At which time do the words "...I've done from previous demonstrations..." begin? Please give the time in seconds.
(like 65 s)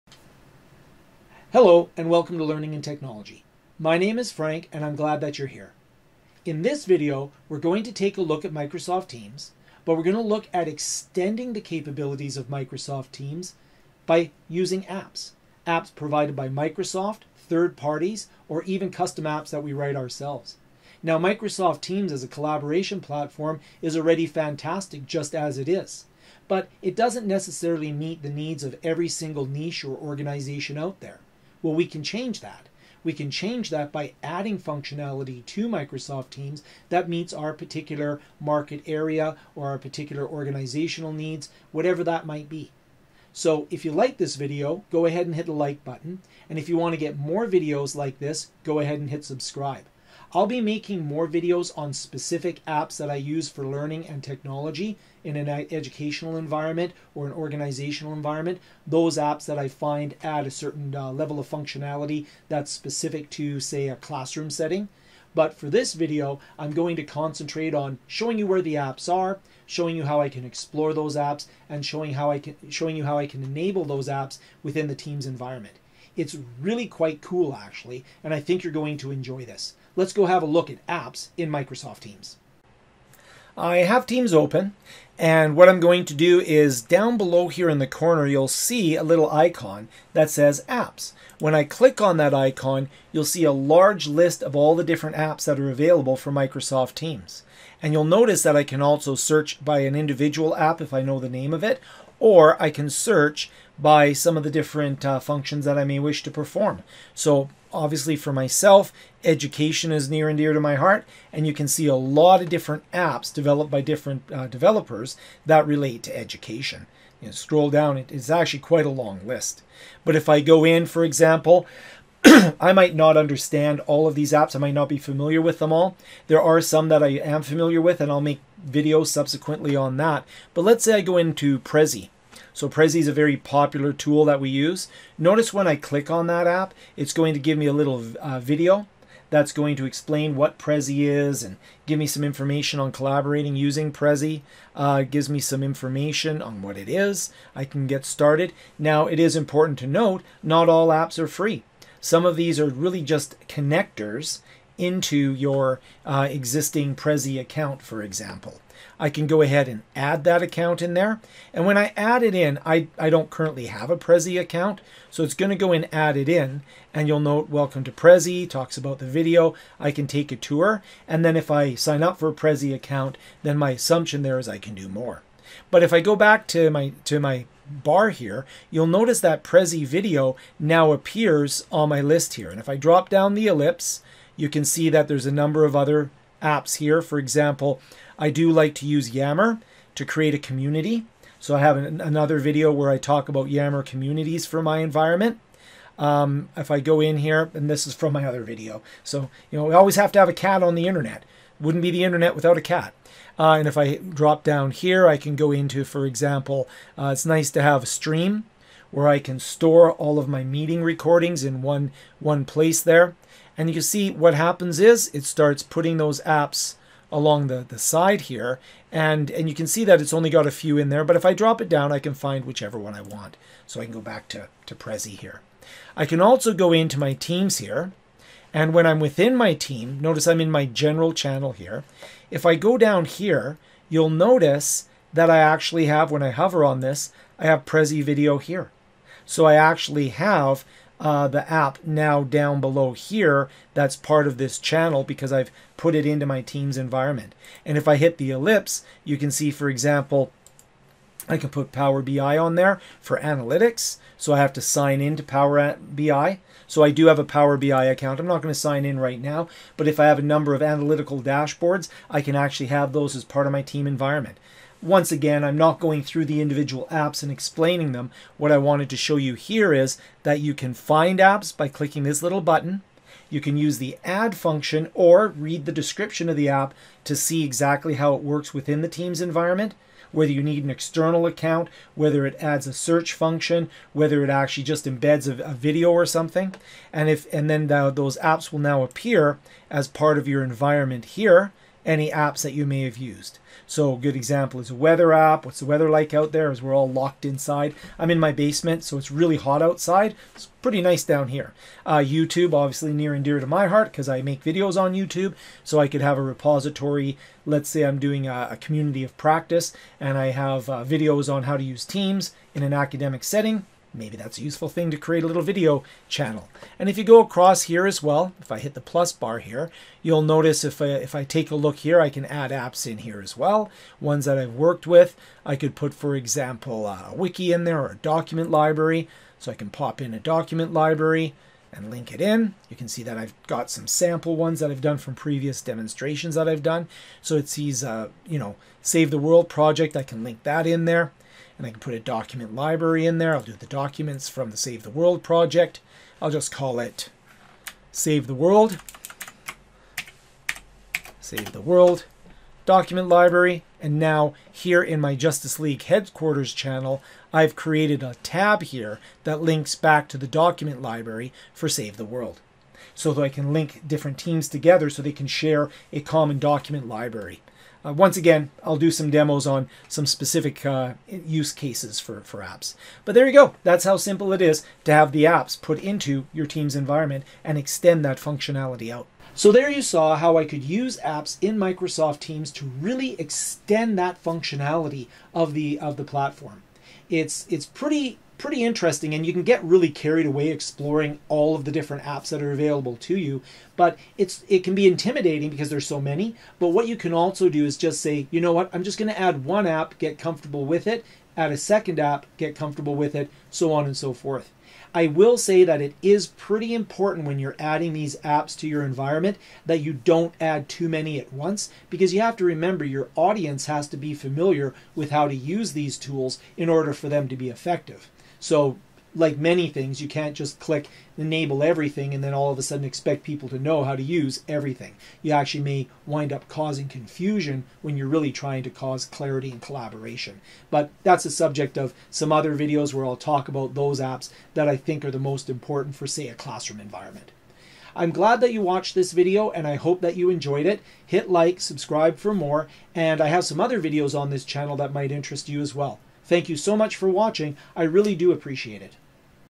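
334 s.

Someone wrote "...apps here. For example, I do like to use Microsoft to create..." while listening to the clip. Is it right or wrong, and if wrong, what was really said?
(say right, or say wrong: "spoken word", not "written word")
wrong: "Yammer", not "Microsoft".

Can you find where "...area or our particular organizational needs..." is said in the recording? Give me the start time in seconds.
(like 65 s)
38 s.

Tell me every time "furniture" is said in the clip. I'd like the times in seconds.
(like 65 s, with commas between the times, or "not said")
not said.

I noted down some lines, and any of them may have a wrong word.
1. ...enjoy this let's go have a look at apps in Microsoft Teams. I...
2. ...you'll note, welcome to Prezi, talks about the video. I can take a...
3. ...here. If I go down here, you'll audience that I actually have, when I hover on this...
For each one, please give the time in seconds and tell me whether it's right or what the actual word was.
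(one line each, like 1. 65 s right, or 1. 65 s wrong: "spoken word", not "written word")
1. 79 s right
2. 167 s right
3. 231 s wrong: "notice", not "audience".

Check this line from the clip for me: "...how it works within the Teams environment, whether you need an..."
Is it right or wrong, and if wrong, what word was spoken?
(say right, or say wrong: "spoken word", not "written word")
right.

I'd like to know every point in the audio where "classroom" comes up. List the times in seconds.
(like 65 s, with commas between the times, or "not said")
63 s, 436 s.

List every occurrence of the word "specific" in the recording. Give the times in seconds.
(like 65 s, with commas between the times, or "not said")
51 s, 62 s, 370 s.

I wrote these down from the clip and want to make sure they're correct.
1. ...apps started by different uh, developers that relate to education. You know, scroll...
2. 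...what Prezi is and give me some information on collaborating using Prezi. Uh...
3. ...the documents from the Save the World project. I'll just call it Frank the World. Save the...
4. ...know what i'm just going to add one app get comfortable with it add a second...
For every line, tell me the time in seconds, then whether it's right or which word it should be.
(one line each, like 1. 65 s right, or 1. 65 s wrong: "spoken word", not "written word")
1. 112 s wrong: "developed", not "started"
2. 140 s right
3. 343 s wrong: "Save", not "Frank"
4. 398 s right.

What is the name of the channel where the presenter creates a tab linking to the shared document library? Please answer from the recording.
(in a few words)
Justice League headquarters.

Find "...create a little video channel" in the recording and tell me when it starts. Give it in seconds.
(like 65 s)
314 s.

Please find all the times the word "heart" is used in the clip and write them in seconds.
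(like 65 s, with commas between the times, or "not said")
110 s, 303 s.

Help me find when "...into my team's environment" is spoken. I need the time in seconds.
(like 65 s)
246 s.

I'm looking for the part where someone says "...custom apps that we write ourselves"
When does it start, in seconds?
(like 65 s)
18 s.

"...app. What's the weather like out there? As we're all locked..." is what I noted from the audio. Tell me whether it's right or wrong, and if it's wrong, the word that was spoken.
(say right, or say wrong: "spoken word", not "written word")
right.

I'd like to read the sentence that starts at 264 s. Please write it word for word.
Once again, I'm not going through the individual apps and explaining them.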